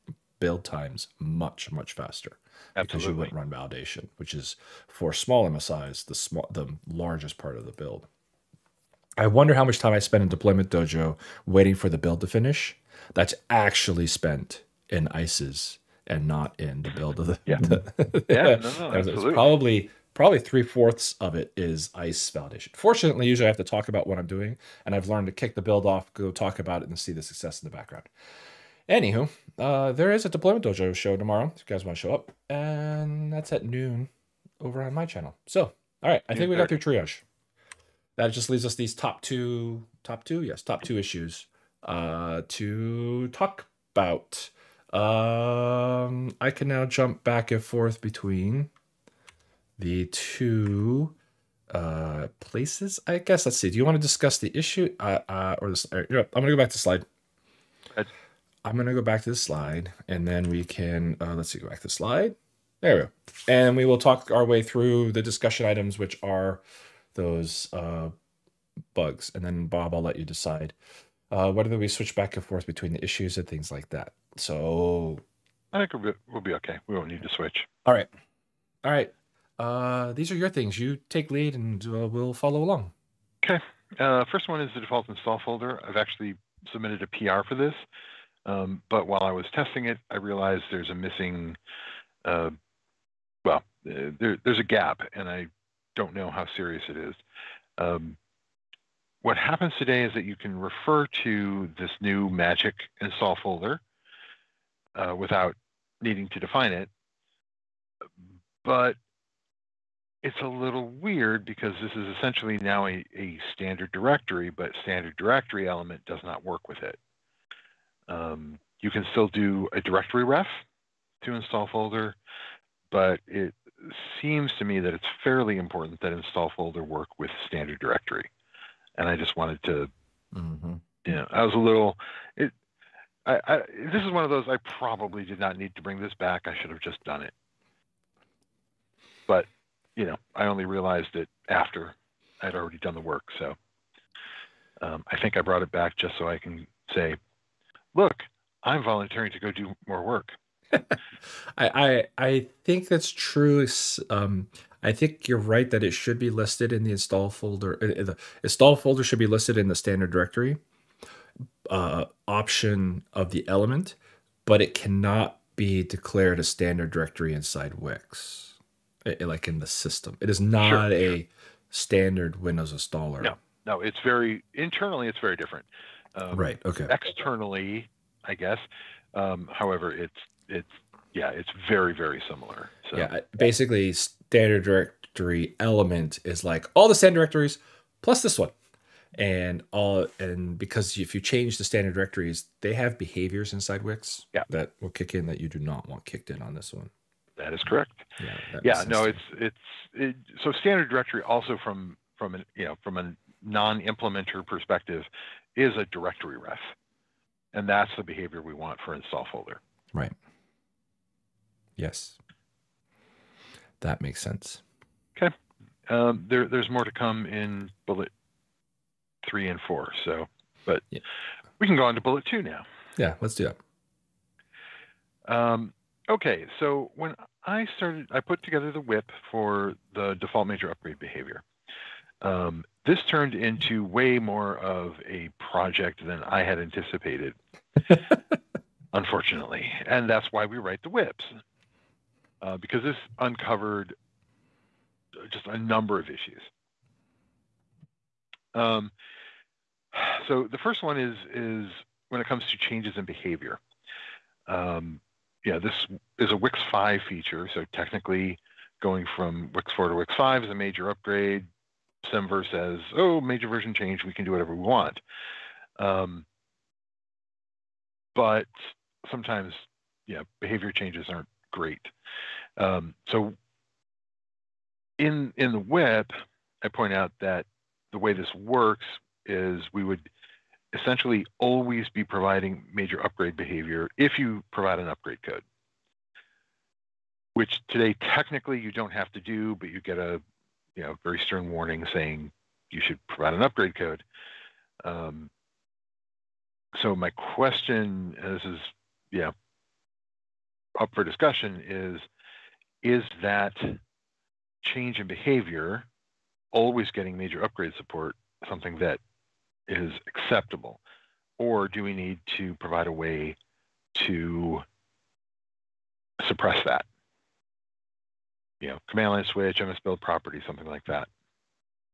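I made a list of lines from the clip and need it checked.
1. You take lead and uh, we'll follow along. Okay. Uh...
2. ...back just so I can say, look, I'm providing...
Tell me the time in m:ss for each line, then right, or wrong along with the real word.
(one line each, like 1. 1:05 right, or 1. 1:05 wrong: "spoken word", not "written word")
1. 1:20 right
2. 2:25 wrong: "volunteering", not "providing".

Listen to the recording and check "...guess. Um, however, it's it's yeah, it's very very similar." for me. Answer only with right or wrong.
right.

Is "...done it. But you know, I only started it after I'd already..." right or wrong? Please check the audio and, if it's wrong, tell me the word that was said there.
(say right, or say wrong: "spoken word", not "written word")
wrong: "realized", not "started".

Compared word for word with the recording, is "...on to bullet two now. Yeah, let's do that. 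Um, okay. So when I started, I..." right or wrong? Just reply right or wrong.
right.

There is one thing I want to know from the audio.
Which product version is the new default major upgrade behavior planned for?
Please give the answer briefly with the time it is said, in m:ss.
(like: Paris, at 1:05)
Wix 5, at 4:16.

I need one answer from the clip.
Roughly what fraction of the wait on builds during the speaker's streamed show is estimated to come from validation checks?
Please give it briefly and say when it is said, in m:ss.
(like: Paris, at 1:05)
three fourths, at 0:20.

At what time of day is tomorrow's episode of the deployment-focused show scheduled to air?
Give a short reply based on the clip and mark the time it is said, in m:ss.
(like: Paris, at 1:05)
noon, at 0:33.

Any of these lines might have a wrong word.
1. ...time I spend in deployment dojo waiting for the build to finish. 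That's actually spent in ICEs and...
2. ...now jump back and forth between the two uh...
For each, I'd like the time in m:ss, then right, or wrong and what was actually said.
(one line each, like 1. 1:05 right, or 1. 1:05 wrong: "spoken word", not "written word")
1. 0:09 right
2. 0:46 right.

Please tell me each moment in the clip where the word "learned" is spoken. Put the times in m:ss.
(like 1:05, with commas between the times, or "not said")
0:25.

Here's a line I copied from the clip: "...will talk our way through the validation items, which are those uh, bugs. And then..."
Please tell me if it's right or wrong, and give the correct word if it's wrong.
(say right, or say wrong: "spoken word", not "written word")
wrong: "discussion", not "validation".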